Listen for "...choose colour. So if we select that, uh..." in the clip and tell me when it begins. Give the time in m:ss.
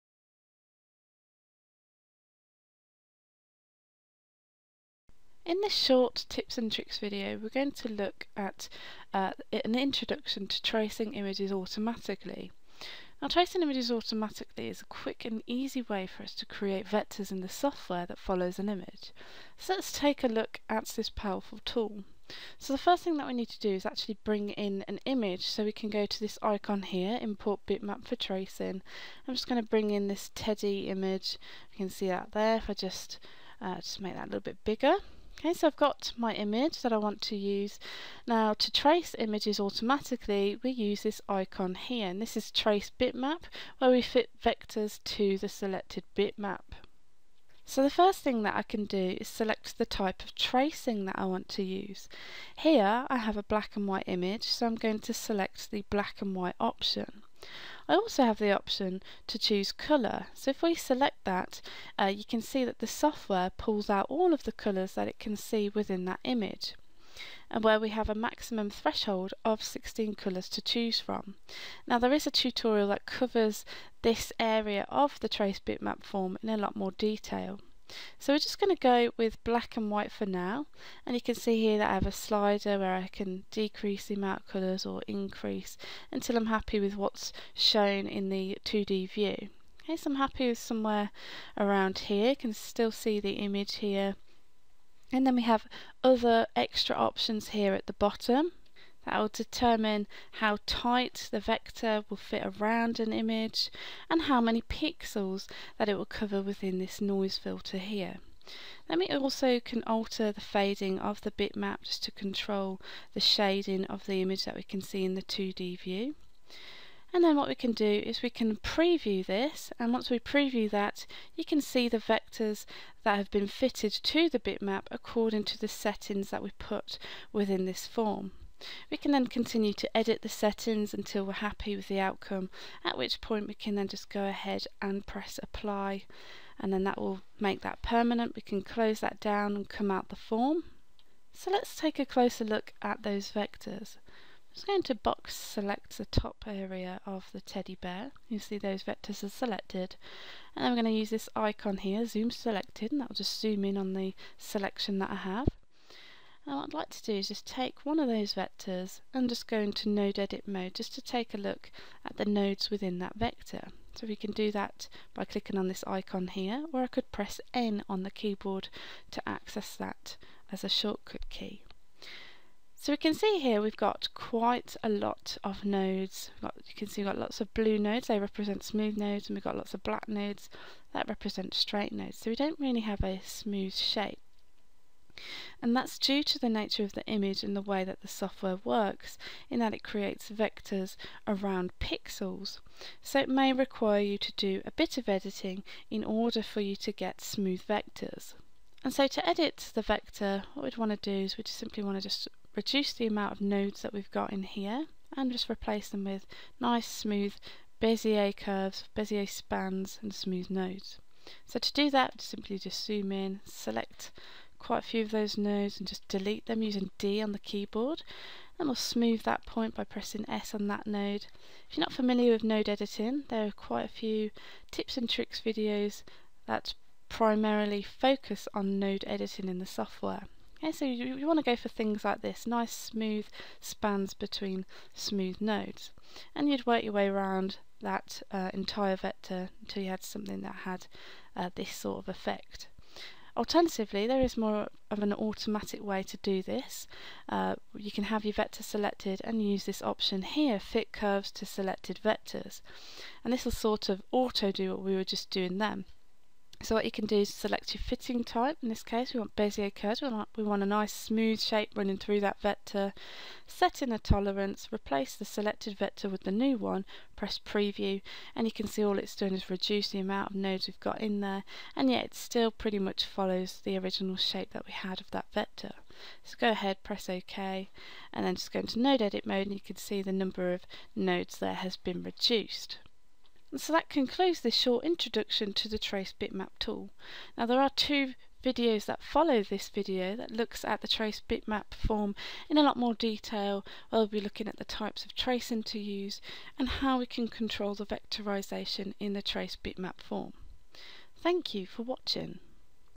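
0:59.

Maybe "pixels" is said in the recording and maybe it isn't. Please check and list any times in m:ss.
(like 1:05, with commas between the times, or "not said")
1:44, 3:11.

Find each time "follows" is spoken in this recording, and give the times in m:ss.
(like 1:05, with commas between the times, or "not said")
0:18, 4:33, 4:49.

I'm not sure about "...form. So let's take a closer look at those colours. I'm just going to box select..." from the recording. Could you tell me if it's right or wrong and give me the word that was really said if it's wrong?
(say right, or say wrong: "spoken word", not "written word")
wrong: "vectors", not "colours".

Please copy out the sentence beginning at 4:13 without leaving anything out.
And this will sort of auto do what we were just doing then.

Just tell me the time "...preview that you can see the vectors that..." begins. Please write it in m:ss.
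2:00.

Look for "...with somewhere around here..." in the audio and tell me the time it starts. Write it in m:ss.
1:30.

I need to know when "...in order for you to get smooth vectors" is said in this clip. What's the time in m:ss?
3:15.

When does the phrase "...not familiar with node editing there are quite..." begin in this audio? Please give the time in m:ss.
3:41.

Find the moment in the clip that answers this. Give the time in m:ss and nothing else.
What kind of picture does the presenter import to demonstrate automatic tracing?
0:30.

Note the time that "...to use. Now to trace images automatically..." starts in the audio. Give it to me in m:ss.
0:37.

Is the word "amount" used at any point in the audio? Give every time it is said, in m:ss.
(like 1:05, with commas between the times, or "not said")
1:24, 3:23, 4:29.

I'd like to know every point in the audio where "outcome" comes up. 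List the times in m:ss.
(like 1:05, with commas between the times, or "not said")
2:11.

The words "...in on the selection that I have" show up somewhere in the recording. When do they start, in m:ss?
2:33.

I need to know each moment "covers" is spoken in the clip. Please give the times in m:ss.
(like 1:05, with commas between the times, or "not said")
1:13, 1:46.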